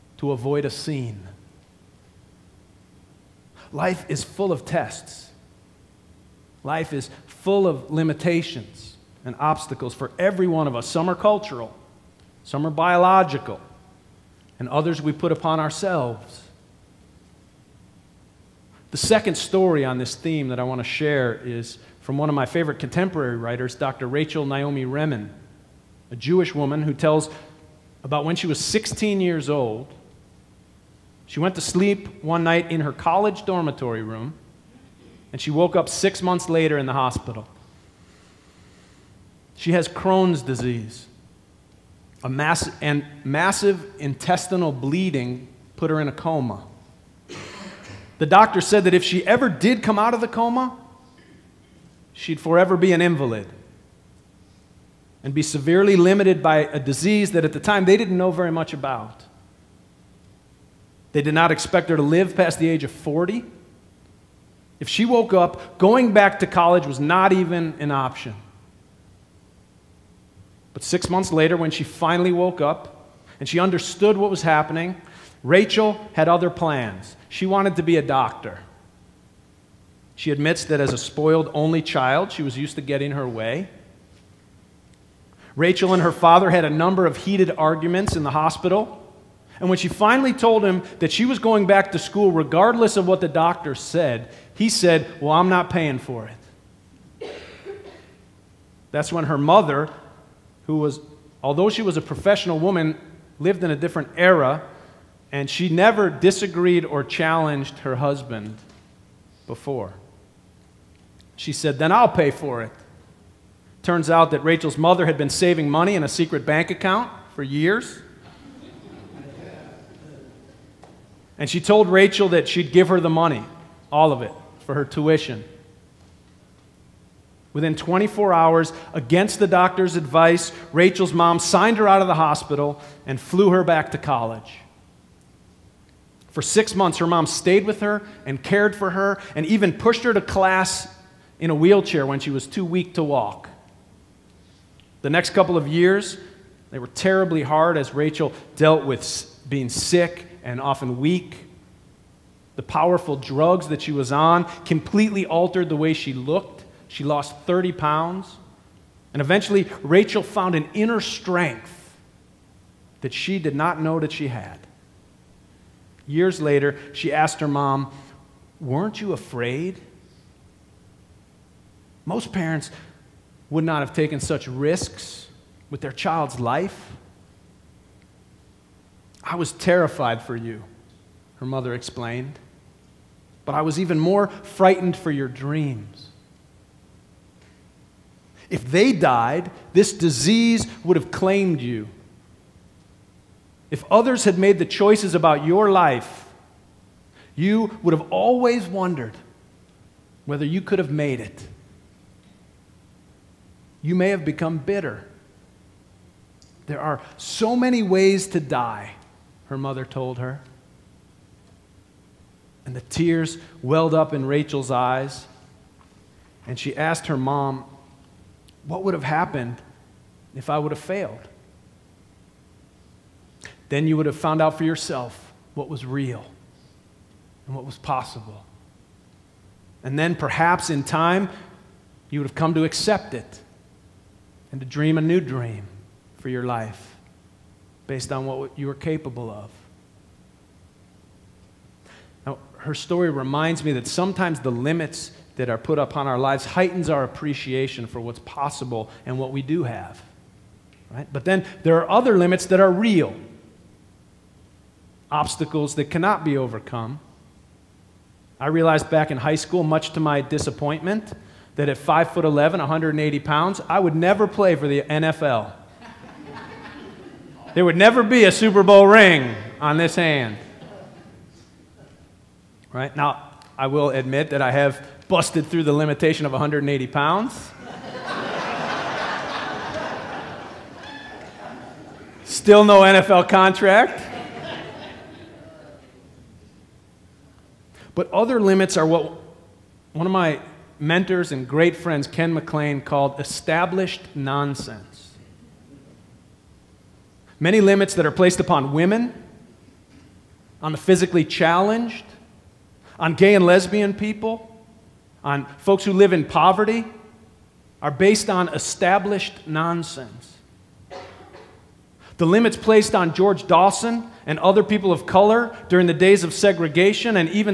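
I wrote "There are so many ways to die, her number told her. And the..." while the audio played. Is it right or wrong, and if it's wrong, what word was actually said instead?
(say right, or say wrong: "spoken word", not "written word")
wrong: "mother", not "number".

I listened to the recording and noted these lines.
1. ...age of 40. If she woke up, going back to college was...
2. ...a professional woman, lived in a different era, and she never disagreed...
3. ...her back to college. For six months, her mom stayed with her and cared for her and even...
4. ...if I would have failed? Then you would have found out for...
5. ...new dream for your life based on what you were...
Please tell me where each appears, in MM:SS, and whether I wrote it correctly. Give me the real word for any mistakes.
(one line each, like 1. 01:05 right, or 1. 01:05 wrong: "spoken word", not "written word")
1. 01:02 right
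2. 01:41 right
3. 02:13 right
4. 03:40 right
5. 03:54 right.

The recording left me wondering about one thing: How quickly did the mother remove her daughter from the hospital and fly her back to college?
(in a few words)
Within 24 hours.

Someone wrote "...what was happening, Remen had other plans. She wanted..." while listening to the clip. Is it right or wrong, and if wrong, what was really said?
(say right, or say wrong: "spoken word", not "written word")
wrong: "Rachel", not "Remen".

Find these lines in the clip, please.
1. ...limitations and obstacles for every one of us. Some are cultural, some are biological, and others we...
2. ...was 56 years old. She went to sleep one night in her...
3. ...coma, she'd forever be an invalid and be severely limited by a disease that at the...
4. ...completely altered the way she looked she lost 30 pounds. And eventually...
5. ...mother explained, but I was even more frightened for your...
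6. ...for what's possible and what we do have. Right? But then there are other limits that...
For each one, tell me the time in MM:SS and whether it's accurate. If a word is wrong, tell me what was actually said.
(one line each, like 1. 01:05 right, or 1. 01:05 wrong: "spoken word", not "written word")
1. 00:07 right
2. 00:28 wrong: "16", not "56"
3. 00:50 right
4. 02:34 right
5. 03:01 right
6. 04:07 right.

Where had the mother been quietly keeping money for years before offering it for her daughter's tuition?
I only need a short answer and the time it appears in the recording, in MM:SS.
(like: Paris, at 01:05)
a secret bank account, at 01:56.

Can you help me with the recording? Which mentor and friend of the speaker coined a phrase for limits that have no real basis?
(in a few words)
Ken McLean.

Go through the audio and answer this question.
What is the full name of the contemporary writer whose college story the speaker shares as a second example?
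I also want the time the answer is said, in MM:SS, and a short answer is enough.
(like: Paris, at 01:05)
Rachel Naomi Remen, at 00:24.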